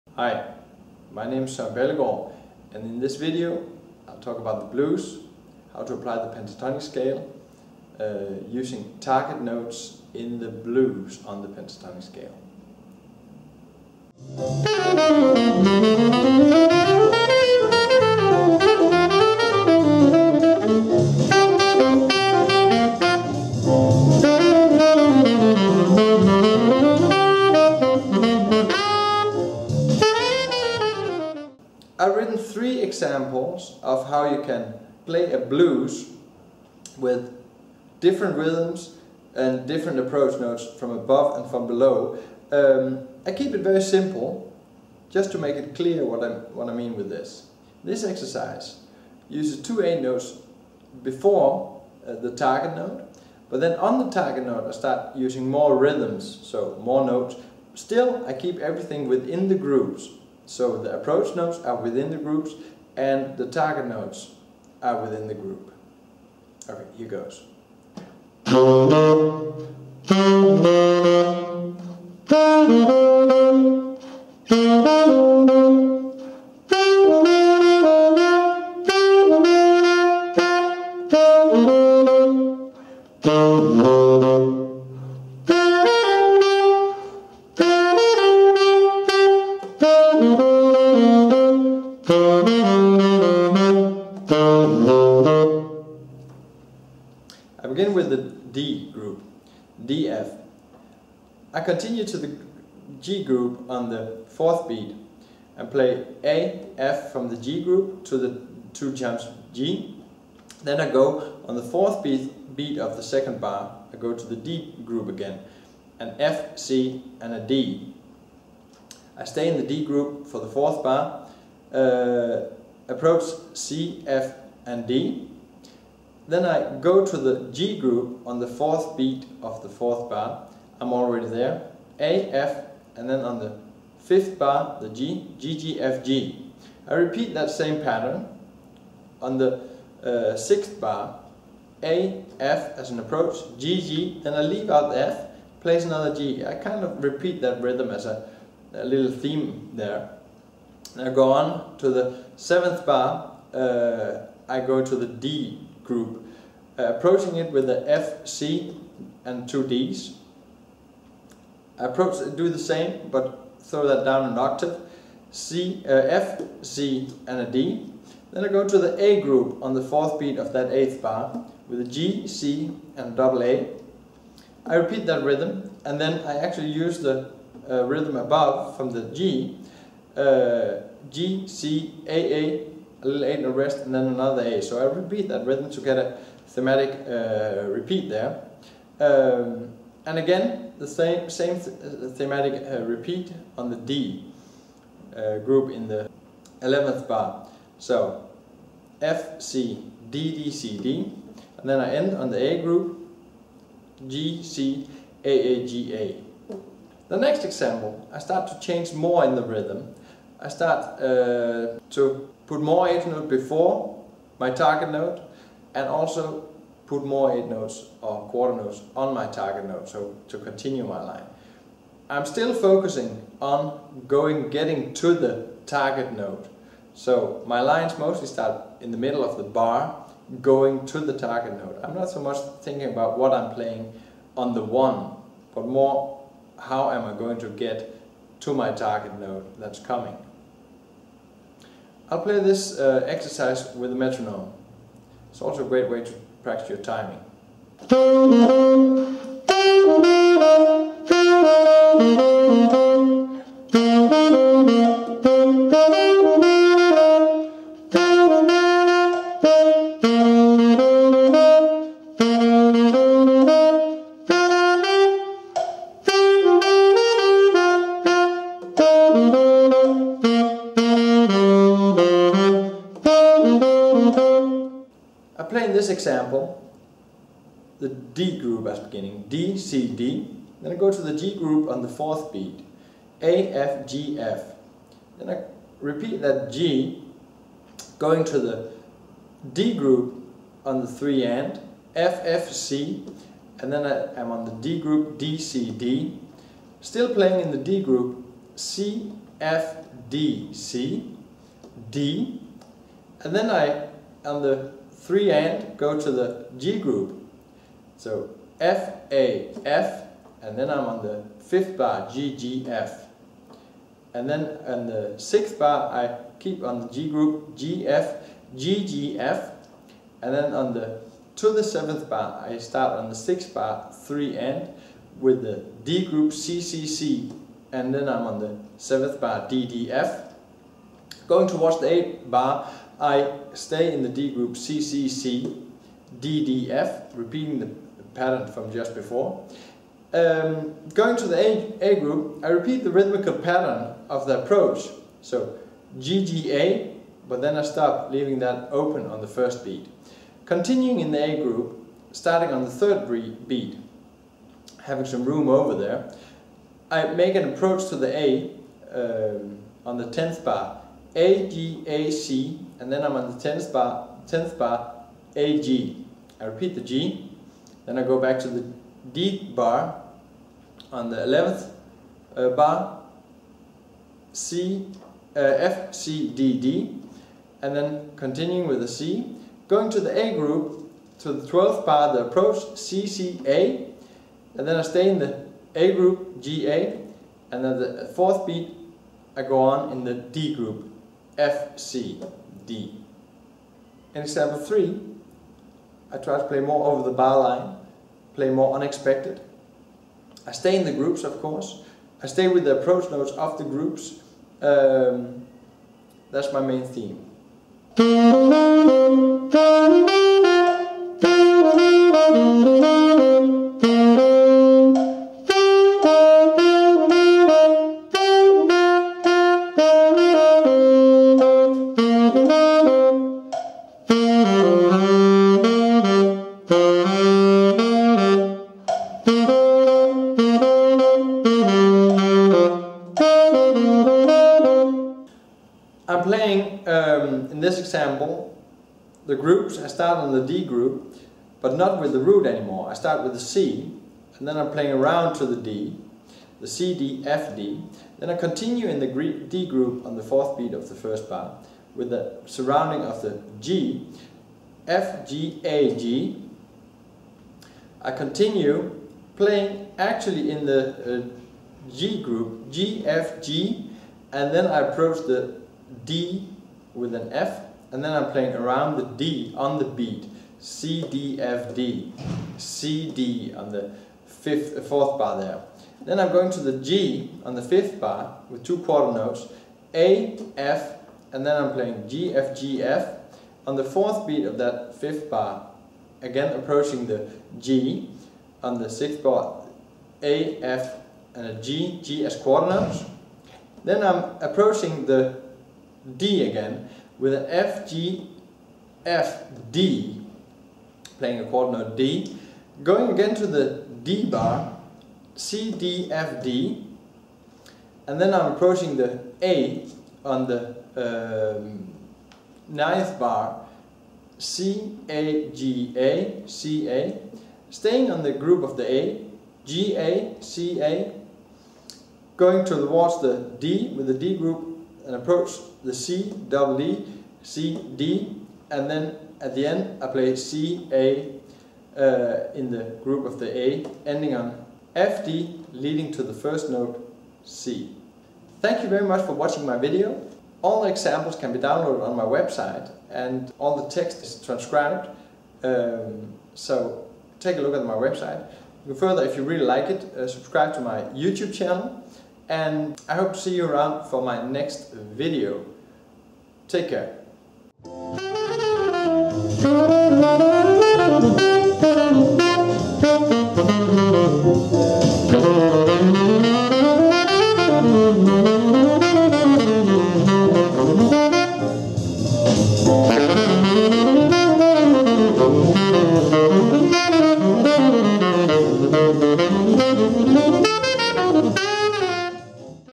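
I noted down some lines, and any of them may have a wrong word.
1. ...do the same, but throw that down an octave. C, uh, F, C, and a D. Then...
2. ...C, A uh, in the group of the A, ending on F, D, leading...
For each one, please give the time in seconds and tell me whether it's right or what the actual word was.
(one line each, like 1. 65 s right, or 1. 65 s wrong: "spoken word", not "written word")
1. 162 s right
2. 530 s right.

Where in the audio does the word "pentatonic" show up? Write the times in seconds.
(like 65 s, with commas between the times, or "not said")
6 s, 11 s.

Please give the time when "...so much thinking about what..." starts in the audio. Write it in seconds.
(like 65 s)
232 s.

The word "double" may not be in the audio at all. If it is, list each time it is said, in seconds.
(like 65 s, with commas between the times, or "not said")
173 s, 526 s.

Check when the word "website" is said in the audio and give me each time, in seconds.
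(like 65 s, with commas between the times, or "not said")
542 s, 547 s.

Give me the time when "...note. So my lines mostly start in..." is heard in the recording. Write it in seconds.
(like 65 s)
226 s.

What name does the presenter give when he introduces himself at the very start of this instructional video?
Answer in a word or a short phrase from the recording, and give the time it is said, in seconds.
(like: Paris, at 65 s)
Sam Ballegaard, at 1 s.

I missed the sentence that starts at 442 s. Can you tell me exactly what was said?
I start with the C, and then I'm playing around to the D, the C, D, F, D.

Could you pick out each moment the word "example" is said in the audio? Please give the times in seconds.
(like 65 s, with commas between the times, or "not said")
33 s, 207 s, 275 s, 394 s, 437 s, 540 s.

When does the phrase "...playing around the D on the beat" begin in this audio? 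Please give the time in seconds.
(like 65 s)
468 s.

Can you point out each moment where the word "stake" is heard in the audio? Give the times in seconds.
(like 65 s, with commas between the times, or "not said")
not said.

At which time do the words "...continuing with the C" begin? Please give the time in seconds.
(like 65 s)
378 s.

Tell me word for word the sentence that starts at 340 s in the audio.
Um, going to the A, A group, I repeat the rhythmical pattern of the approach.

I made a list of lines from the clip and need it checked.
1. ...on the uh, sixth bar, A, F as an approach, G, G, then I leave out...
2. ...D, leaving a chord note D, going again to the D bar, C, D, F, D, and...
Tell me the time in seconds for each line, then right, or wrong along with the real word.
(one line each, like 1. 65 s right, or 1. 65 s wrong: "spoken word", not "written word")
1. 139 s right
2. 499 s wrong: "playing", not "leaving".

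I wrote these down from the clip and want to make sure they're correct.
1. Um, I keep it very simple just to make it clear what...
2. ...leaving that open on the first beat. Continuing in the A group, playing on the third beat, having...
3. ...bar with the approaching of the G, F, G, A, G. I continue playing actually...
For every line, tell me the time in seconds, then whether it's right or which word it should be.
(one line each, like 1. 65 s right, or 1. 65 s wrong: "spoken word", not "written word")
1. 42 s right
2. 348 s wrong: "starting", not "playing"
3. 451 s wrong: "surrounding", not "approaching".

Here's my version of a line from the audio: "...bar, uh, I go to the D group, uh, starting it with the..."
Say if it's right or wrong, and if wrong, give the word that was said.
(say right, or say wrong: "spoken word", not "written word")
wrong: "approaching", not "starting".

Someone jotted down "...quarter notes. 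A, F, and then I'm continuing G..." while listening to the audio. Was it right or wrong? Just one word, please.
wrong.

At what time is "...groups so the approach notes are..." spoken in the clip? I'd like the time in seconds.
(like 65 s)
59 s.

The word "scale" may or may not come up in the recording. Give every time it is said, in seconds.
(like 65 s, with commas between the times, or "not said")
6 s, 12 s.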